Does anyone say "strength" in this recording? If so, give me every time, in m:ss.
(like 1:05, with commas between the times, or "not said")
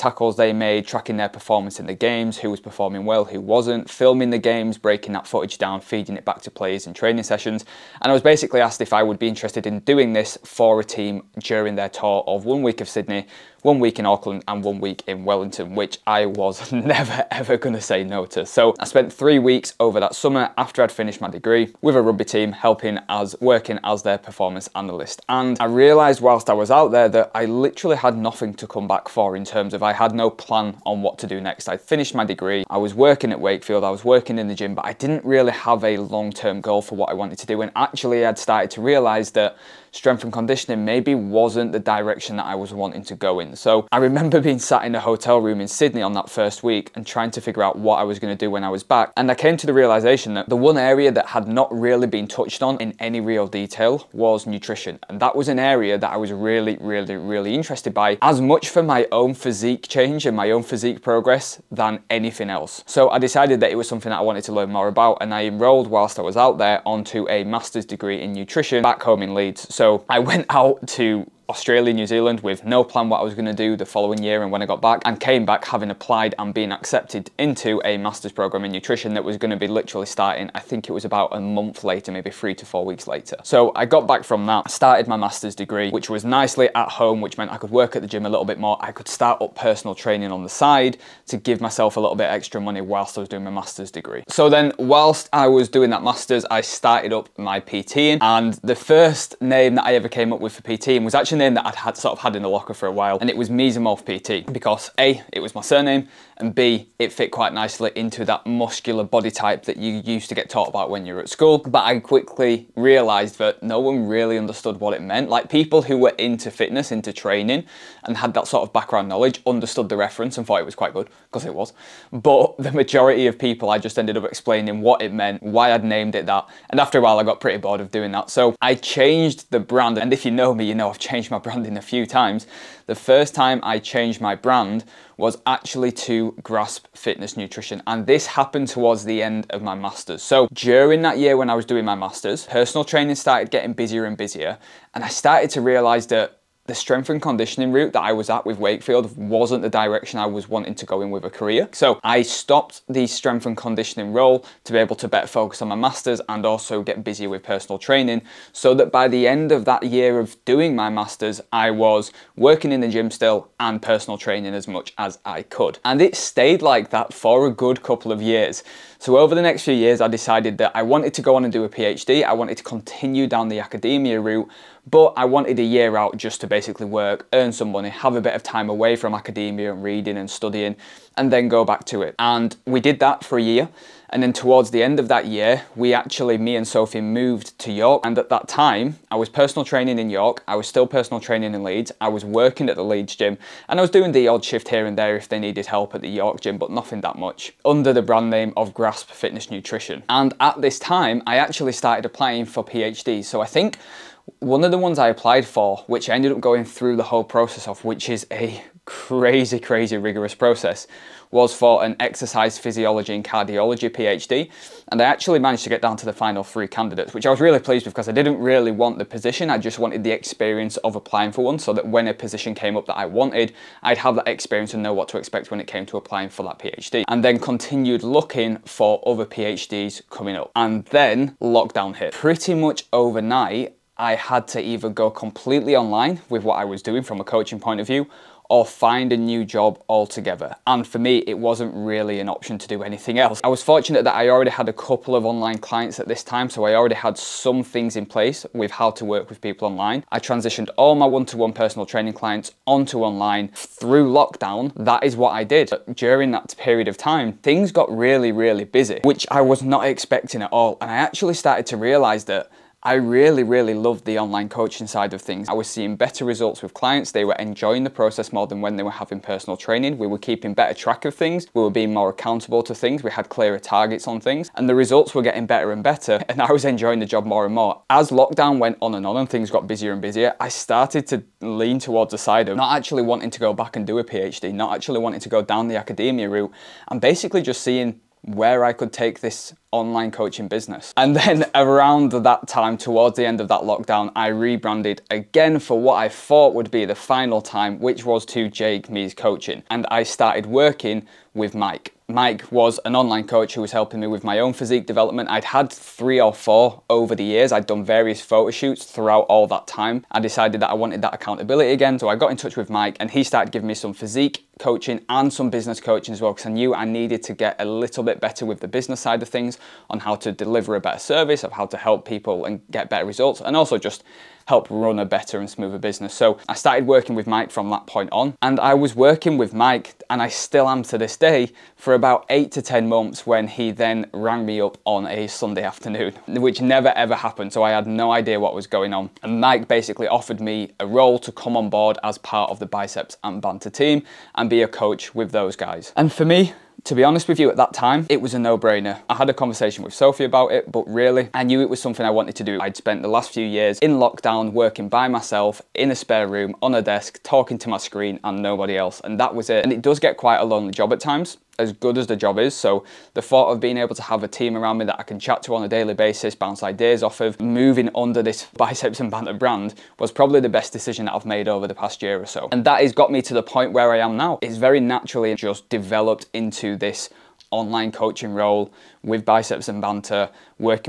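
0:39, 2:26, 2:33.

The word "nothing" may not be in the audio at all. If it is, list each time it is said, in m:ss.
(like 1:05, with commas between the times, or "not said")
0:28, 3:16.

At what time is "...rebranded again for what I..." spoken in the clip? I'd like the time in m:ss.
4:54.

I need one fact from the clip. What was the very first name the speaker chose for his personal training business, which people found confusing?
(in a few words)
Mesomorph PT.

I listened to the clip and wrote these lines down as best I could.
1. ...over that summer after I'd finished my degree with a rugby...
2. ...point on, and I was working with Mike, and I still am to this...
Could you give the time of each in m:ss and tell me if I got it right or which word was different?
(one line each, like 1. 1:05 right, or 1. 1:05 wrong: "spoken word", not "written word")
1. 0:19 right
2. 5:27 right.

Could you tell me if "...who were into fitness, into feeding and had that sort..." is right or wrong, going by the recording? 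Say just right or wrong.
wrong.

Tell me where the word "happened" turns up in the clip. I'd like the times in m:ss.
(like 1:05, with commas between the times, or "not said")
2:18, 5:37.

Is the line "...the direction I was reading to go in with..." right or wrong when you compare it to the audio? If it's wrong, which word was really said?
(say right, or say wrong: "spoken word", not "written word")
wrong: "wanting", not "reading".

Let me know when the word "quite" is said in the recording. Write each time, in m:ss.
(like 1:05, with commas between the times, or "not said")
1:47, 2:00, 6:00.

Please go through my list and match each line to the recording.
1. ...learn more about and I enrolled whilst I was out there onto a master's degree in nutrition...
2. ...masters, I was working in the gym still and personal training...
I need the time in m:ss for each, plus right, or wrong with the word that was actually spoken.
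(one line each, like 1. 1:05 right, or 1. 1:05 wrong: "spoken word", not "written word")
1. 1:04 right
2. 2:40 right.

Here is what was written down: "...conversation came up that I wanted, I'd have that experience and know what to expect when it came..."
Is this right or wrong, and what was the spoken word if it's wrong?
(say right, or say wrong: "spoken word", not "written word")
wrong: "position", not "conversation".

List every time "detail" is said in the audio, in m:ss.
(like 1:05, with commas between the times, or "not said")
0:53.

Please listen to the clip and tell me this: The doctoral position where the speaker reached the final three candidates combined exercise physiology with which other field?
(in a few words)
Cardiology.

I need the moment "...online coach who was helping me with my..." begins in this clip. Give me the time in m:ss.
5:02.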